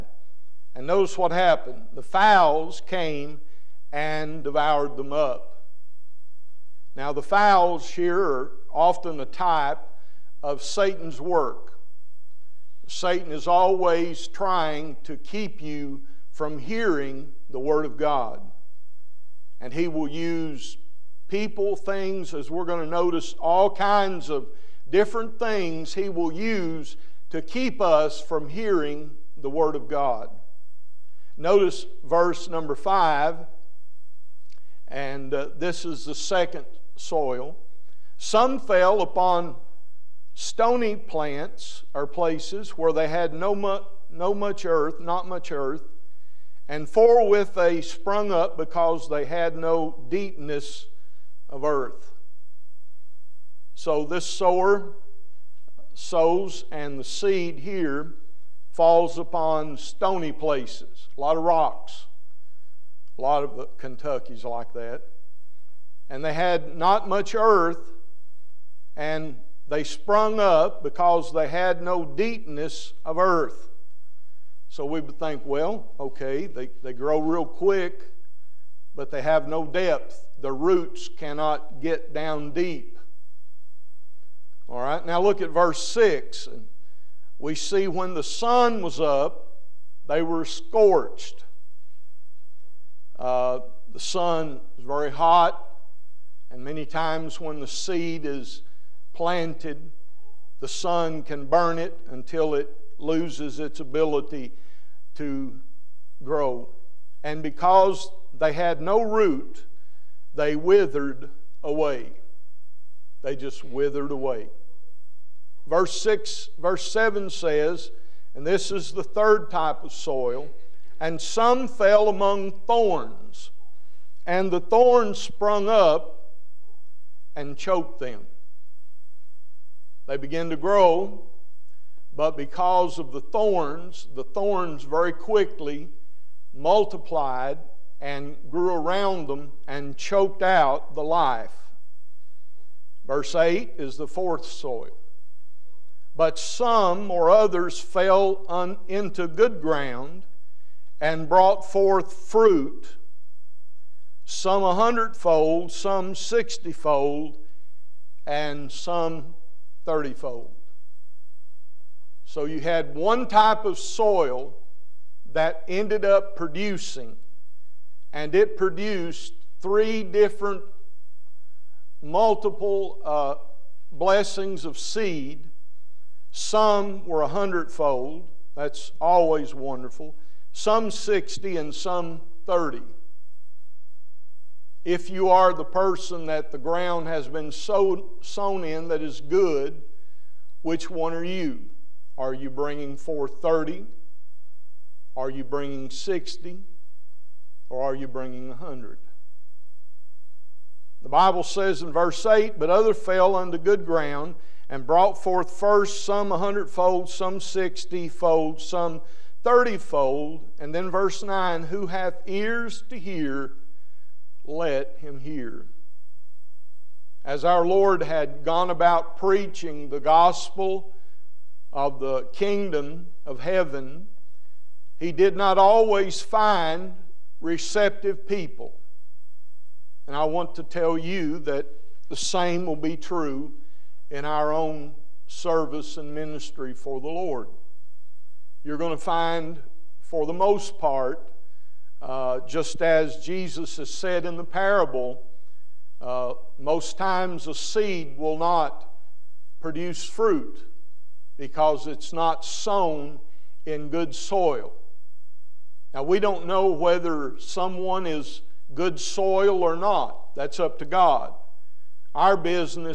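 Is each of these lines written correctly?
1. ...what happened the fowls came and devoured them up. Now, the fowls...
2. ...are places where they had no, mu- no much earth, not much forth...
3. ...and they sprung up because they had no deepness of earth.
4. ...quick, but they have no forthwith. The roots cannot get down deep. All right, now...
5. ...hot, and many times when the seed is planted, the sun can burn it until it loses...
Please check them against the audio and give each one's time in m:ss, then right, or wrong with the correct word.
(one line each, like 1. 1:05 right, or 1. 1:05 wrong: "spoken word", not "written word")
1. 0:01 right
2. 0:41 wrong: "earth", not "forth"
3. 1:08 right
4. 1:17 wrong: "depth", not "forthwith"
5. 1:35 right.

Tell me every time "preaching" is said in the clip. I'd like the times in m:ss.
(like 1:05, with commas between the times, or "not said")
3:39.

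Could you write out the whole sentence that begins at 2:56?
Some were a hundredfold, that's always wonderful, some 60, and some 30.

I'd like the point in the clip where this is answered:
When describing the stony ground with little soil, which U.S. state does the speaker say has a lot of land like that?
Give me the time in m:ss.
1:03.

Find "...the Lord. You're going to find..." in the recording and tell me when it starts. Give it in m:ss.
3:57.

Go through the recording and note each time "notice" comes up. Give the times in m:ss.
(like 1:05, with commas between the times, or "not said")
0:00, 0:22, 0:31.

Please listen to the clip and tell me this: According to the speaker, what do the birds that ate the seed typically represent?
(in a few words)
Satan's work.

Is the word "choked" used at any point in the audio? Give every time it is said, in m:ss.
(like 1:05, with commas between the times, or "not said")
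2:07, 2:19.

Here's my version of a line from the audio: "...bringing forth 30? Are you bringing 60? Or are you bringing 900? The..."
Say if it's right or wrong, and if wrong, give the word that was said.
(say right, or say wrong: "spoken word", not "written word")
wrong: "100", not "900".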